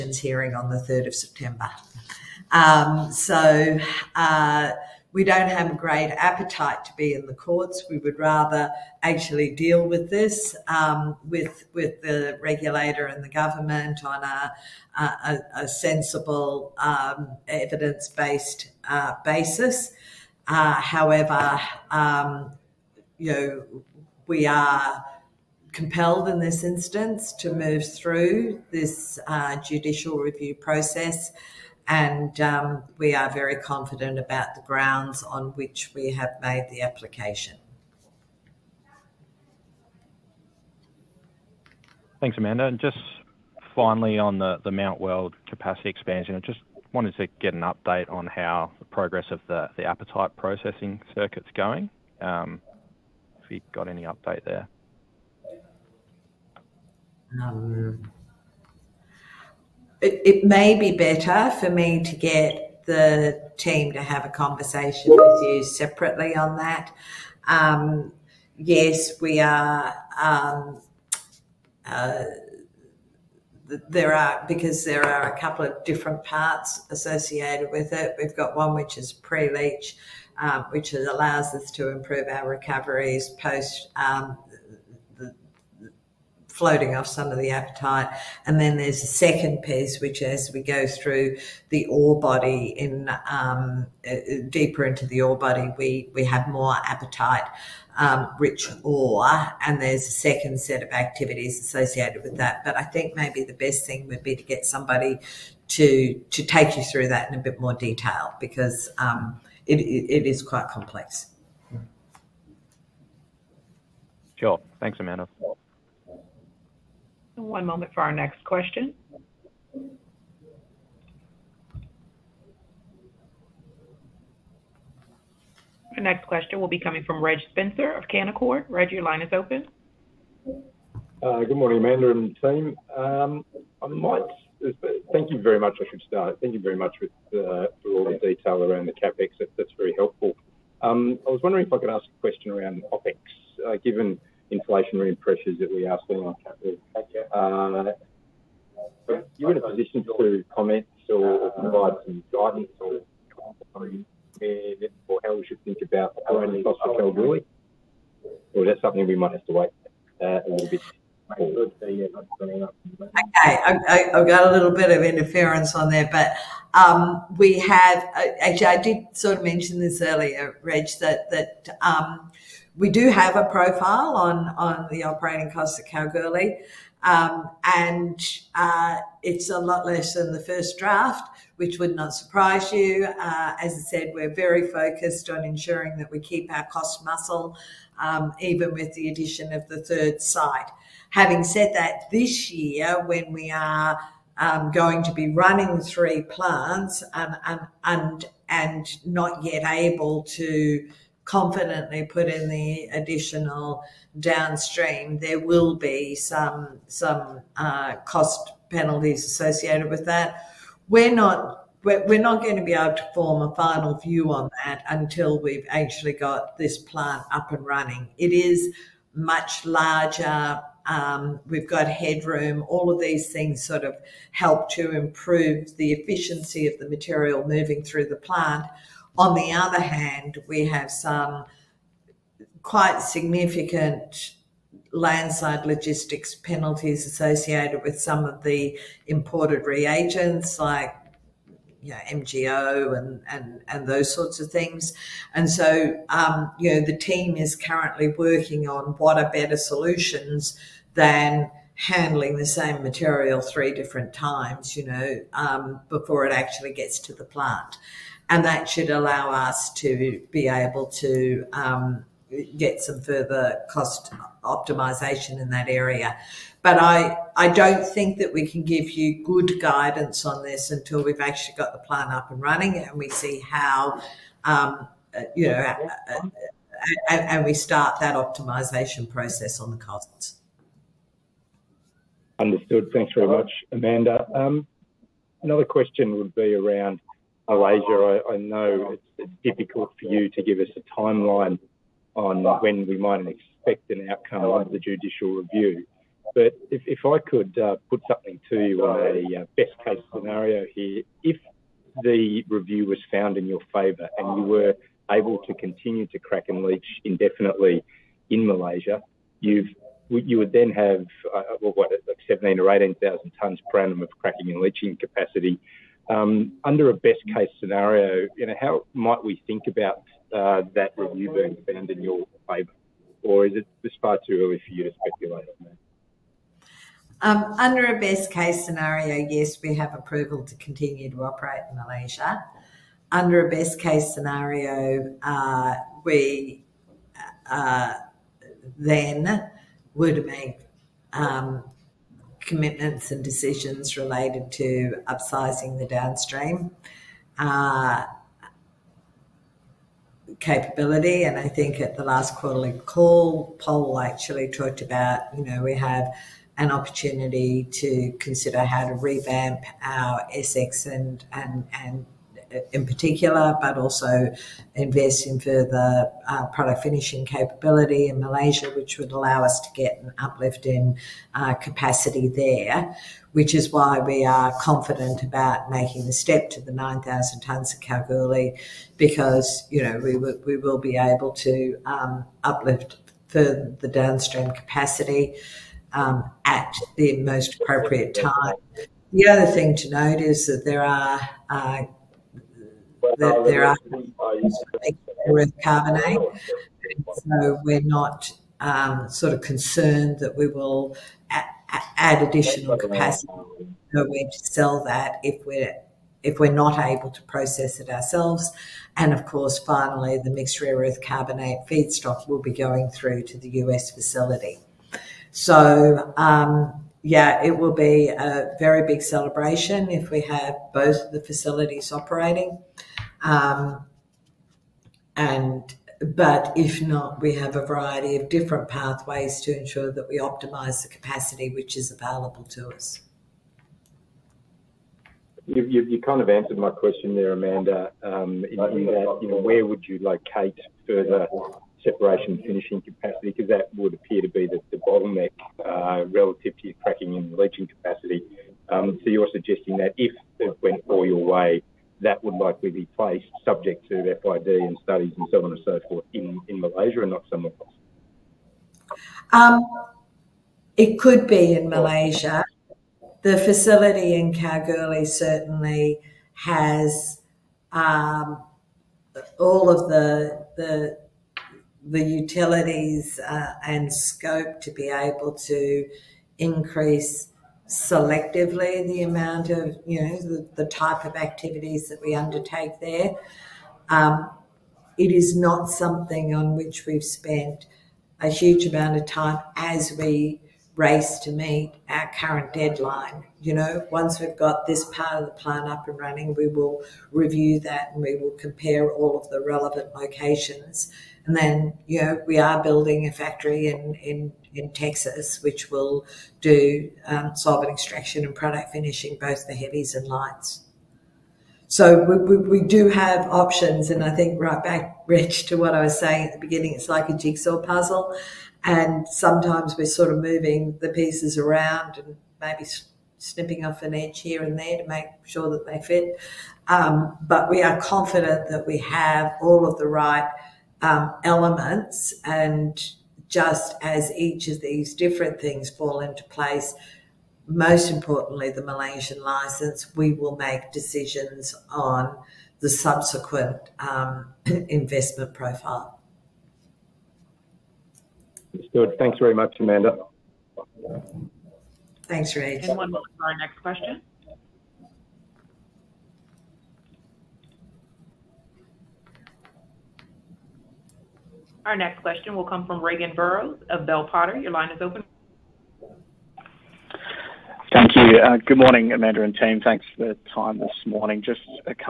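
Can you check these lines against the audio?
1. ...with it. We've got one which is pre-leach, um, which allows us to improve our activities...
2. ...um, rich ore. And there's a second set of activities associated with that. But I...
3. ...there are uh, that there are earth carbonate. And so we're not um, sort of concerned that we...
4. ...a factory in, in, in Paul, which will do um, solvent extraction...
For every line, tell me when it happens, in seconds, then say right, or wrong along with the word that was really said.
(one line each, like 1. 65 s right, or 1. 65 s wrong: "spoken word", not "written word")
1. 77 s wrong: "recoveries", not "activities"
2. 97 s right
3. 390 s right
4. 503 s wrong: "Texas", not "Paul".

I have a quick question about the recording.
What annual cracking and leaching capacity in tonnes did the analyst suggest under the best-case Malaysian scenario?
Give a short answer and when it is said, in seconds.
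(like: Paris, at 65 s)
17 or 18,000 tonnes, at 312 s.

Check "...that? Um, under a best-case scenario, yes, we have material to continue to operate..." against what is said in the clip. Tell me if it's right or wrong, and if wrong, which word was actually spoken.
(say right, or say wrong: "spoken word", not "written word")
wrong: "approval", not "material".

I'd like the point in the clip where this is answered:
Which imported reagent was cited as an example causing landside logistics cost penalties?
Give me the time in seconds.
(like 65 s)
242 s.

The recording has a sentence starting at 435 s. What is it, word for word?
You, you, you kind of answered my question there, Amanda.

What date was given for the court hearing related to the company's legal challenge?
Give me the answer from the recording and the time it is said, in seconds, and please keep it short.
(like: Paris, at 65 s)
3rd of September, at 0 s.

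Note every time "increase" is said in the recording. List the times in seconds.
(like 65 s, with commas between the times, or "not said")
476 s.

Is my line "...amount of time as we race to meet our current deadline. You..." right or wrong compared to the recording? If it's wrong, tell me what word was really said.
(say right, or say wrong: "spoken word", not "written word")
right.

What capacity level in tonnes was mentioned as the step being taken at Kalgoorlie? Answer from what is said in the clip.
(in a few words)
9,000 tonnes.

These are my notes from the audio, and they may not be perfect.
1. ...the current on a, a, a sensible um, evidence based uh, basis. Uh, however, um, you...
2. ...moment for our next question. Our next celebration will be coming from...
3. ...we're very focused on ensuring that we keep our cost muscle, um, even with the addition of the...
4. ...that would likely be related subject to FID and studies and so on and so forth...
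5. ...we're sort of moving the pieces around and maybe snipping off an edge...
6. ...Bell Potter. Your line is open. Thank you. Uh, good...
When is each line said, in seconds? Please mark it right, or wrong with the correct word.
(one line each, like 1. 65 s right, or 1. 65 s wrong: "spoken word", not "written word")
1. 13 s wrong: "government", not "current"
2. 117 s wrong: "question", not "celebration"
3. 184 s right
4. 452 s wrong: "placed", not "related"
5. 519 s right
6. 563 s right.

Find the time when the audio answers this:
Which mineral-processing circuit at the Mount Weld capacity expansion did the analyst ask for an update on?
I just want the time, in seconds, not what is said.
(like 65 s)
49 s.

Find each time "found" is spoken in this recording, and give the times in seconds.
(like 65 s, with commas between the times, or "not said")
303 s, 321 s.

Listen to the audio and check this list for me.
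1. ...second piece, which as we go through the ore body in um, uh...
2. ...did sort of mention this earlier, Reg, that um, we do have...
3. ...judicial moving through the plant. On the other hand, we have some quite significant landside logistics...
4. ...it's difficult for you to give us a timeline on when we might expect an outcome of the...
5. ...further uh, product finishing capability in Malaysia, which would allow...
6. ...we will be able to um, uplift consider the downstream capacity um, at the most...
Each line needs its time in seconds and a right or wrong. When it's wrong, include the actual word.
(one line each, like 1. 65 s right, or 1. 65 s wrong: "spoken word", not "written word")
1. 89 s right
2. 168 s right
3. 226 s wrong: "material", not "judicial"
4. 289 s right
5. 365 s right
6. 380 s wrong: "further", not "consider".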